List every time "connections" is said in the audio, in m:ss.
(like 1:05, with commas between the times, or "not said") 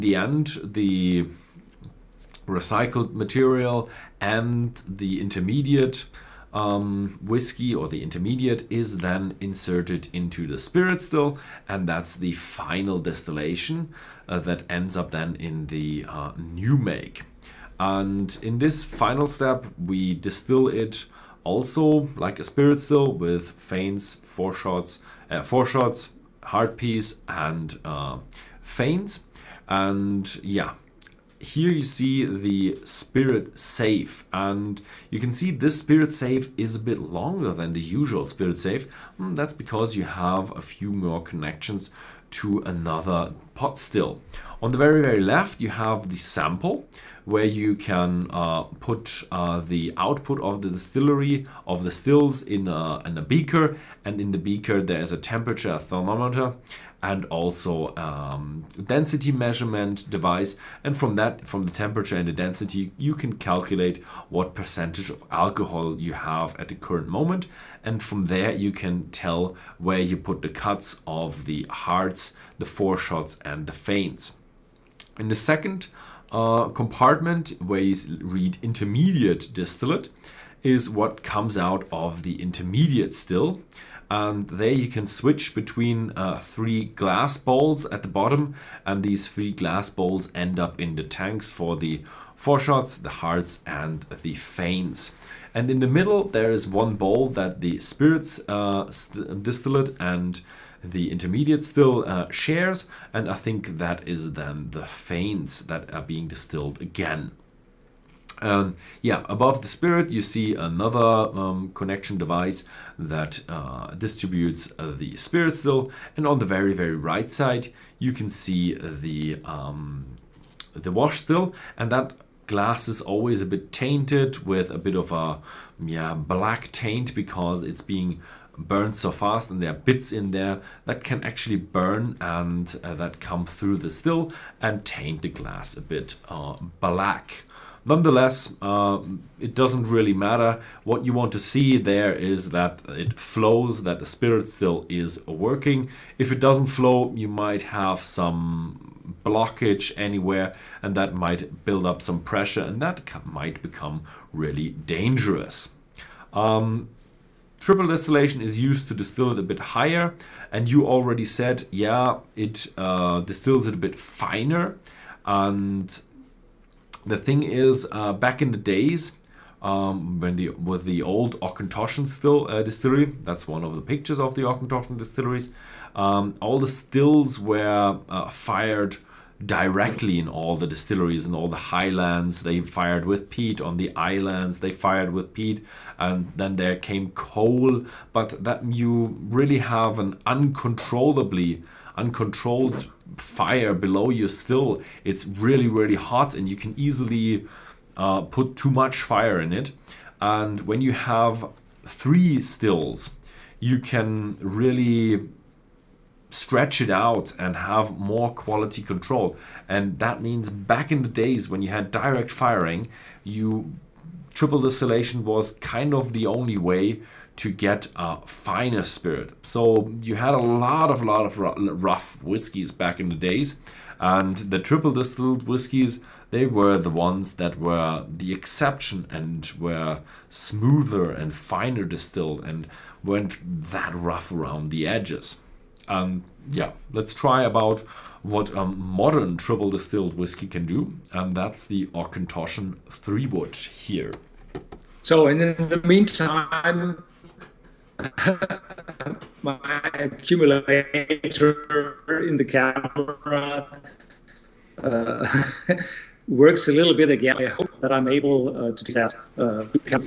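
0:41, 1:51.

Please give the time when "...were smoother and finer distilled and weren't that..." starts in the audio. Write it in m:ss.
3:49.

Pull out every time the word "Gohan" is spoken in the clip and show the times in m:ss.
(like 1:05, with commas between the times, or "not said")
not said.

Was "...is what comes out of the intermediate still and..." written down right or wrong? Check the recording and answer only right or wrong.
right.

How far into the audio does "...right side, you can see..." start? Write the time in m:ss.
1:56.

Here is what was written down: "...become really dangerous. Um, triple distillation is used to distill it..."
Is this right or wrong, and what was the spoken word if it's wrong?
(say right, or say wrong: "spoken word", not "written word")
right.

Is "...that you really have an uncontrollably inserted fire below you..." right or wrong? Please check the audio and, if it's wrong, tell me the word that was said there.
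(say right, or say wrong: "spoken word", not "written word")
wrong: "uncontrolled", not "inserted".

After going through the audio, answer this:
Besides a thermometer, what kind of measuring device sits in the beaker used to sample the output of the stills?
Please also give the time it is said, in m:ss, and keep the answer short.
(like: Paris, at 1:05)
Density measurement device, at 0:58.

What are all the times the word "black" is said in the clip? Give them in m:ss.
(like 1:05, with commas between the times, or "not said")
2:06, 2:16.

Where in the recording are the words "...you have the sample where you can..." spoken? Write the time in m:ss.
0:45.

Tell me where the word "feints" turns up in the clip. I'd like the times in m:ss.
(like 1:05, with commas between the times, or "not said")
0:23, 0:28, 1:13, 1:34, 1:44.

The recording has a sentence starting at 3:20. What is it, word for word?
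And when you have three stills, you can really stretch it out and have more quality control.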